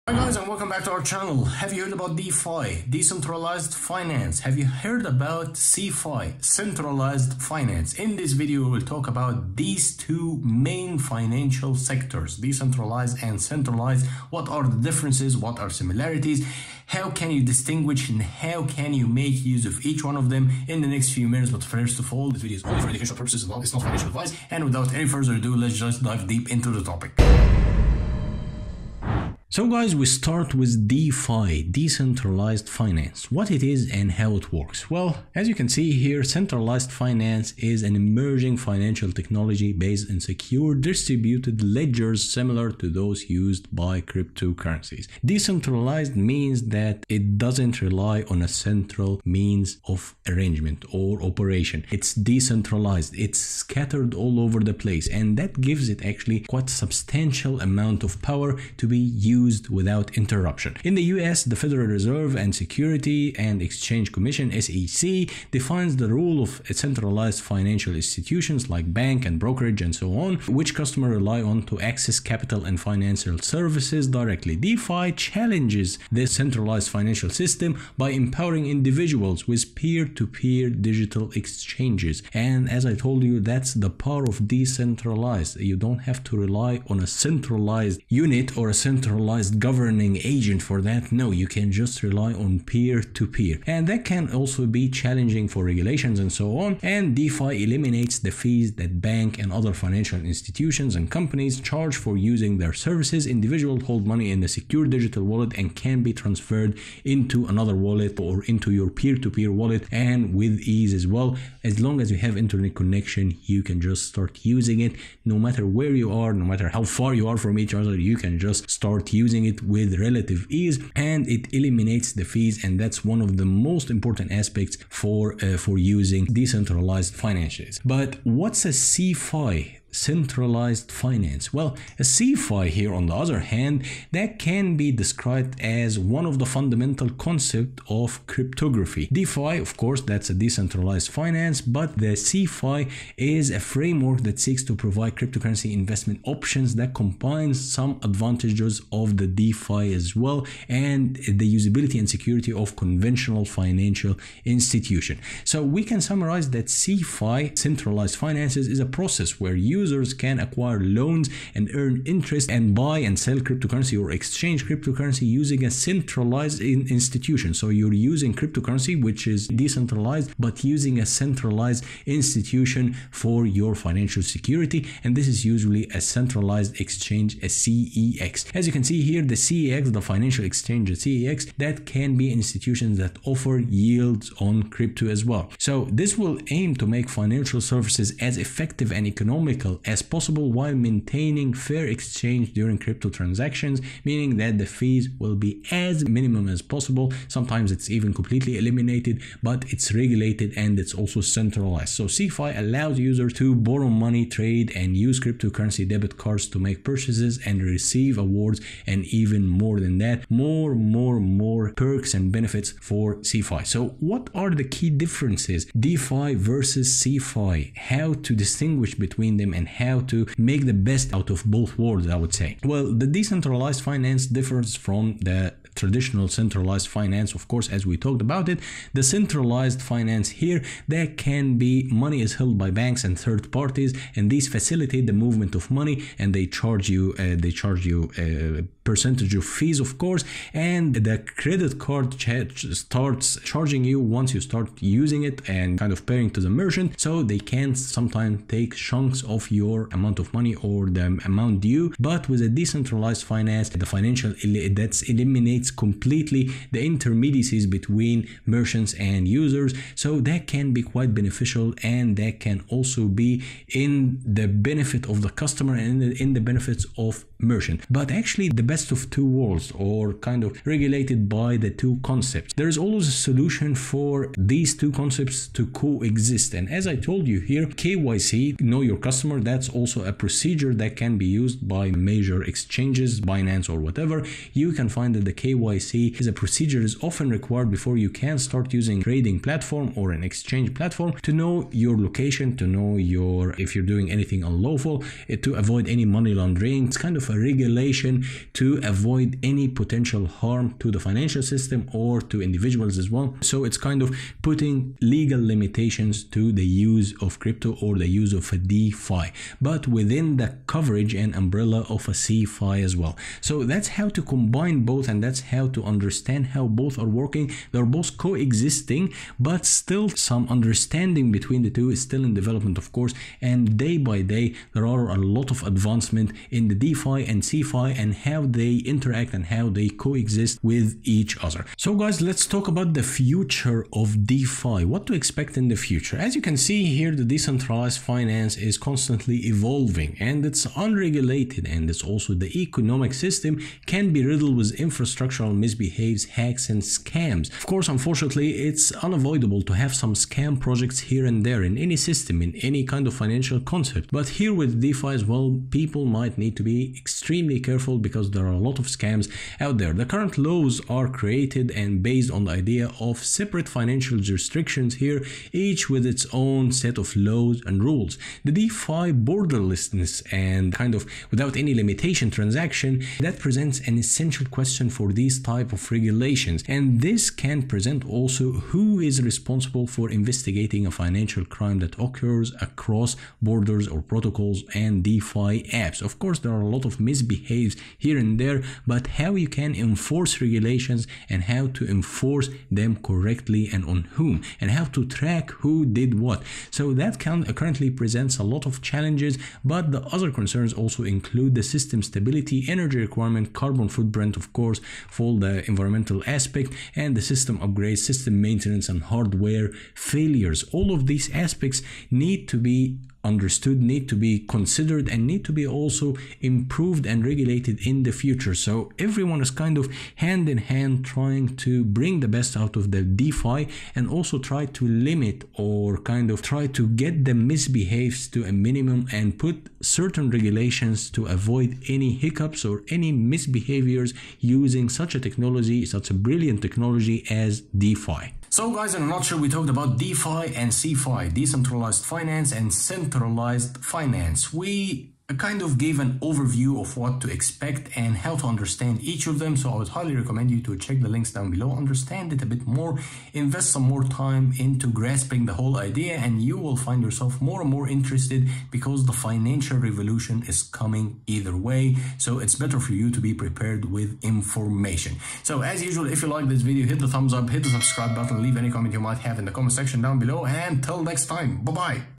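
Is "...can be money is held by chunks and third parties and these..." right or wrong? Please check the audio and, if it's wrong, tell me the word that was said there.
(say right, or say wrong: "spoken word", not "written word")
wrong: "banks", not "chunks".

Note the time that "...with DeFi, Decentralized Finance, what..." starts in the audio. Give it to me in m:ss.
0:30.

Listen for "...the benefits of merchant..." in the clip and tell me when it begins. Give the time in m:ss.
4:26.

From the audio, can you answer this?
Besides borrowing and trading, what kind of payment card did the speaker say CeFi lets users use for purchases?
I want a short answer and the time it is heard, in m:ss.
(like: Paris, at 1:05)
cryptocurrency debit cards, at 3:25.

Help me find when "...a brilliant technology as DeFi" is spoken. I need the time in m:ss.
7:16.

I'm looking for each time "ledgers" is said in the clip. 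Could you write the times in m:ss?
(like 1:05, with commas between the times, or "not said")
0:41.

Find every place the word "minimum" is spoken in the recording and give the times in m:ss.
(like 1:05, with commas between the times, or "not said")
3:16, 7:08.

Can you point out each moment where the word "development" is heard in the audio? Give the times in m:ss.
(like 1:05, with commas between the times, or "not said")
5:22.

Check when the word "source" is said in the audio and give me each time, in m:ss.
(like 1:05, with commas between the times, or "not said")
not said.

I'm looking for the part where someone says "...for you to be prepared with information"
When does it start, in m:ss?
7:42.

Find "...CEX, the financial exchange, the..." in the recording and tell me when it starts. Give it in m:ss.
2:59.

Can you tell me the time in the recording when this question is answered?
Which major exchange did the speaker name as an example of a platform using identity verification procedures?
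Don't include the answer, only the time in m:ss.
4:43.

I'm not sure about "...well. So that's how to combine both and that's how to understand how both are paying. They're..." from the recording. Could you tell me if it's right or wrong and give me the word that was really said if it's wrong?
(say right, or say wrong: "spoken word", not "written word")
wrong: "working", not "paying".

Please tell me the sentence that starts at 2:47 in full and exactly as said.
So you're using cryptocurrency, which is decentralized, but using a centralized institution for your financial security.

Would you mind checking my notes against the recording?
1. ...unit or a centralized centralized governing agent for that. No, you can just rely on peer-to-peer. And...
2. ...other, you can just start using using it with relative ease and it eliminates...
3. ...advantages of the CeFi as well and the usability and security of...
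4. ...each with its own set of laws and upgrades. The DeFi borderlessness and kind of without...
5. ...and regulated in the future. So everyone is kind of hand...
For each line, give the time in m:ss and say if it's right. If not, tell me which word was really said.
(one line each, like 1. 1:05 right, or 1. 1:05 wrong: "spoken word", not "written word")
1. 1:28 right
2. 1:57 right
3. 2:28 wrong: "DeFi", not "CeFi"
4. 6:05 wrong: "rules", not "upgrades"
5. 6:57 right.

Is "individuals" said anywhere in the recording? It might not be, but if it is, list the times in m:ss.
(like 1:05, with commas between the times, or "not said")
1:18, 1:43, 5:02.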